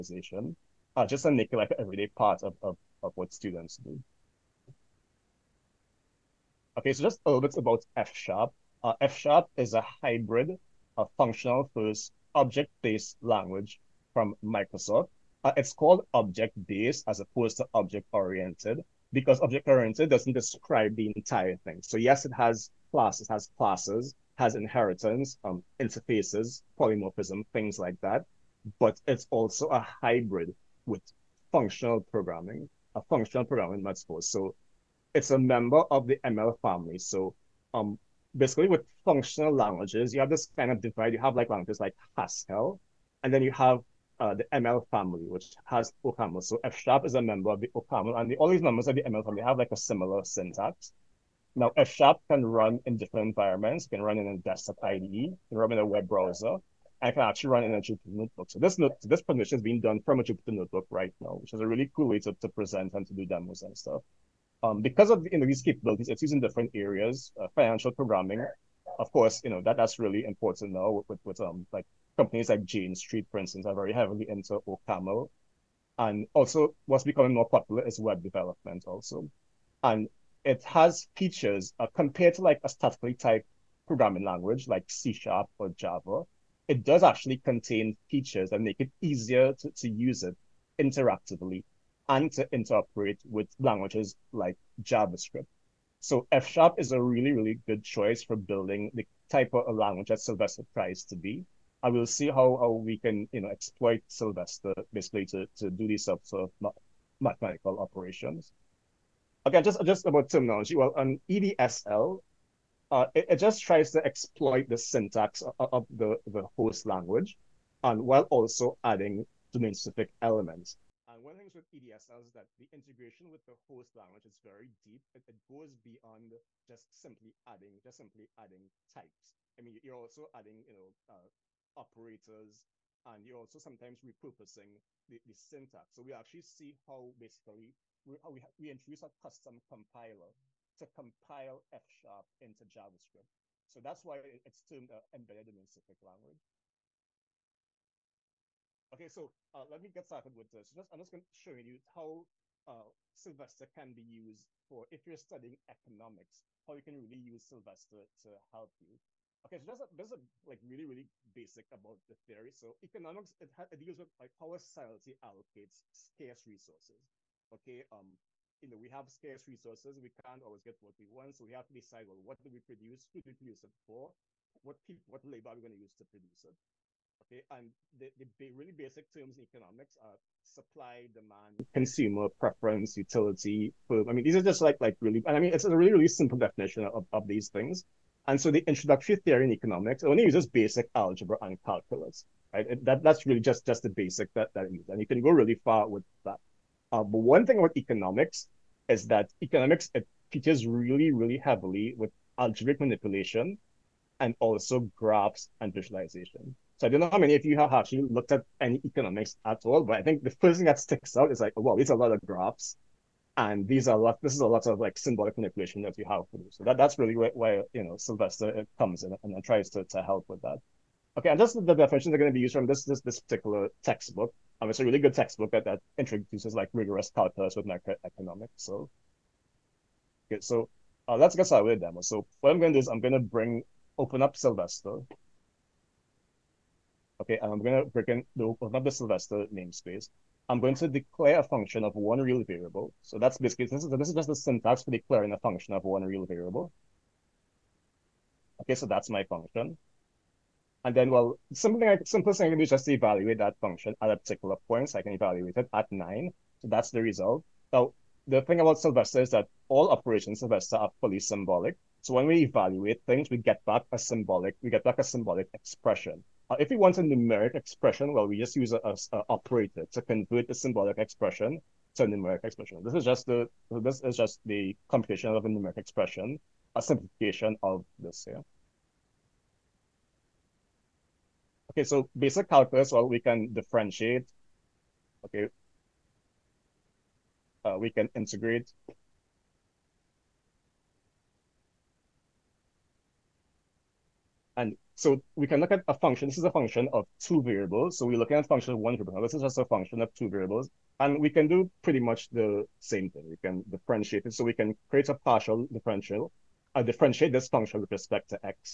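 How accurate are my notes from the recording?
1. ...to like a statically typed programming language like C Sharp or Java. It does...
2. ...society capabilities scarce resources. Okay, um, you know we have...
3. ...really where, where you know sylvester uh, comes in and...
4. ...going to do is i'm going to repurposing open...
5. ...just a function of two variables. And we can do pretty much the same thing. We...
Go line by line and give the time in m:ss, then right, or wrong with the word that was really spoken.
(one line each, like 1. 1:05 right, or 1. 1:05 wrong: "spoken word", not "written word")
1. 1:22 right
2. 2:44 wrong: "allocates", not "capabilities"
3. 3:36 right
4. 3:52 wrong: "bring", not "repurposing"
5. 4:59 right.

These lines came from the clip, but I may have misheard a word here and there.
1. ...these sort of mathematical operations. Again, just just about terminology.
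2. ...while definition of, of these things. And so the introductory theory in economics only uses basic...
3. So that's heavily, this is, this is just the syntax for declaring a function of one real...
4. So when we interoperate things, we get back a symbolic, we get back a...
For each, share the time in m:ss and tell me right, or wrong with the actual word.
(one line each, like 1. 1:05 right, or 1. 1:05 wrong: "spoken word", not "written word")
1. 1:45 right
2. 3:06 wrong: "simple", not "while"
3. 4:03 wrong: "basically", not "heavily"
4. 4:22 wrong: "evaluate", not "interoperate".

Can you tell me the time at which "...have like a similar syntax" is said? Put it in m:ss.
0:49.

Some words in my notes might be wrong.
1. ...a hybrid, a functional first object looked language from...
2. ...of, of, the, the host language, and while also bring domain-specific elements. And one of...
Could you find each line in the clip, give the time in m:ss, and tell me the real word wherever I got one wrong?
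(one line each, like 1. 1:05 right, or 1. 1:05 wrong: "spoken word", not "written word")
1. 0:09 wrong: "based", not "looked"
2. 1:55 wrong: "adding", not "bring".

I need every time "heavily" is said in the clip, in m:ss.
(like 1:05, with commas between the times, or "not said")
1:13, 3:21.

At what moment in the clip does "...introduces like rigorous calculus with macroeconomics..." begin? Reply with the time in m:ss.
3:45.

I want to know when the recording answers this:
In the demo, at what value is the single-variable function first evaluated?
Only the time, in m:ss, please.
4:15.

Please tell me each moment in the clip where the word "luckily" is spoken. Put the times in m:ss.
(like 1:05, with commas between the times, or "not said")
not said.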